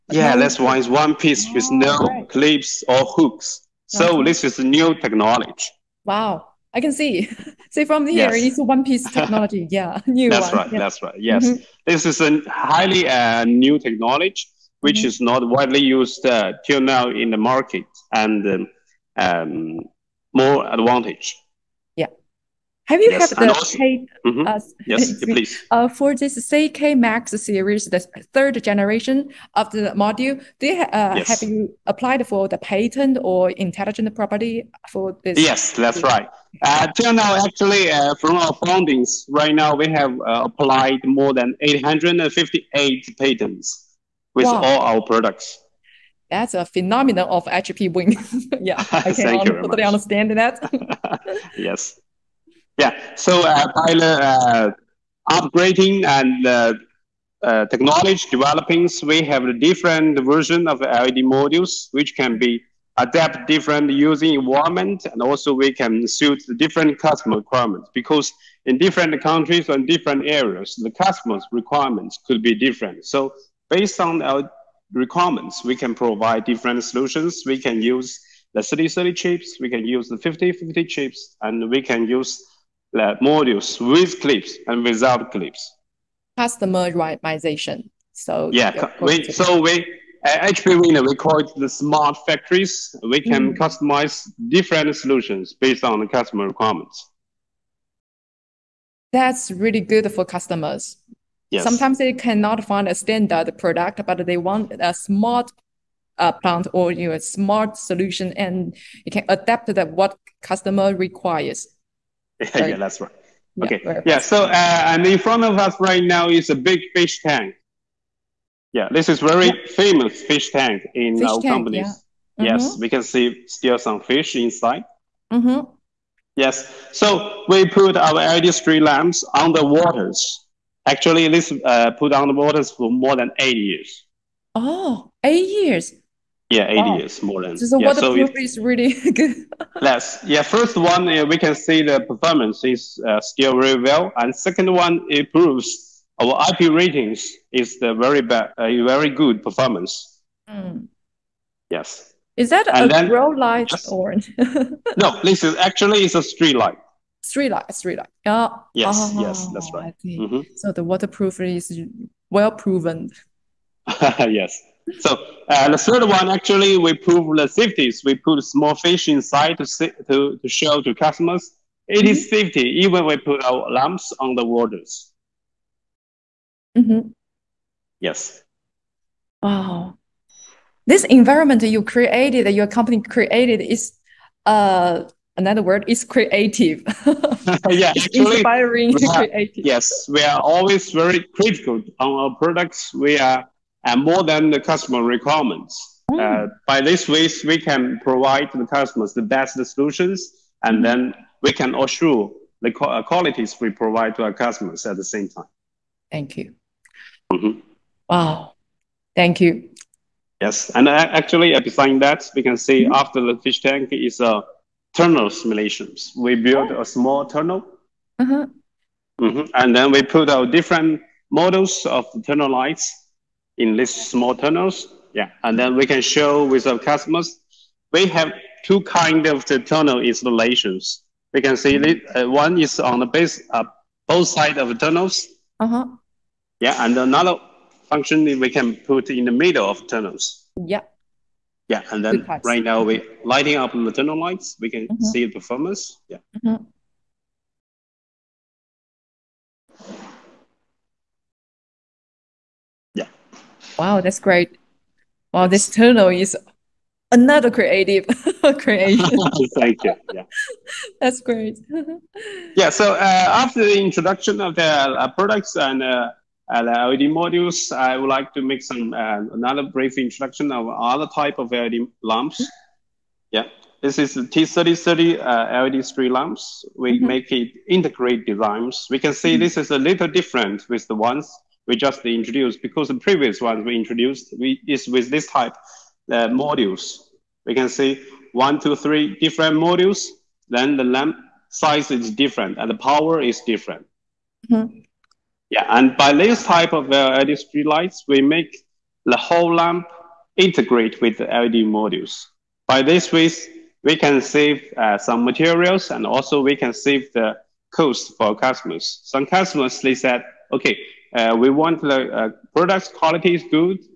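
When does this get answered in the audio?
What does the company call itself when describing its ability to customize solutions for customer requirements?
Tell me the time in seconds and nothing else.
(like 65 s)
91 s.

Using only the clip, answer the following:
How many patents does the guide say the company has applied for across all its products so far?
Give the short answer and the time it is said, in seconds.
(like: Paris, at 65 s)
more than 858, at 41 s.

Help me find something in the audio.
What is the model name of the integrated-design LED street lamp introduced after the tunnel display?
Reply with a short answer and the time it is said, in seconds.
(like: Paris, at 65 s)
T3030, at 274 s.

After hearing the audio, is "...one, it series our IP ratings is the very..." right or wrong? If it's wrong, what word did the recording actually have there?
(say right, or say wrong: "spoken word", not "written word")
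wrong: "proves", not "series".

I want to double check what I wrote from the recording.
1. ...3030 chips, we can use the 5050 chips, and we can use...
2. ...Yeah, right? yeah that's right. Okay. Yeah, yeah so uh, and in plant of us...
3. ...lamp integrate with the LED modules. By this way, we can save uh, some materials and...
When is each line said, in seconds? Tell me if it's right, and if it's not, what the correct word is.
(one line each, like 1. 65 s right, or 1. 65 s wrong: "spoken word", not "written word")
1. 78 s right
2. 112 s wrong: "front", not "plant"
3. 299 s right.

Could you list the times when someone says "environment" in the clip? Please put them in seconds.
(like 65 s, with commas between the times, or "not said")
64 s, 181 s.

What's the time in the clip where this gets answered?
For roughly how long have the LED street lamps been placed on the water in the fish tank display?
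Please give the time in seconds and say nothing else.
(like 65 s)
132 s.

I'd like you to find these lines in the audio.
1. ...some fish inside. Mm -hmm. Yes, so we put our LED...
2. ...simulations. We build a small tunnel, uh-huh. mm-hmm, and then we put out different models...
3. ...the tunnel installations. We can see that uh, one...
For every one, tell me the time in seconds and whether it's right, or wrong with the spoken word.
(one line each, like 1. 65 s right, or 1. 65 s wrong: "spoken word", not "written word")
1. 123 s right
2. 215 s right
3. 229 s right.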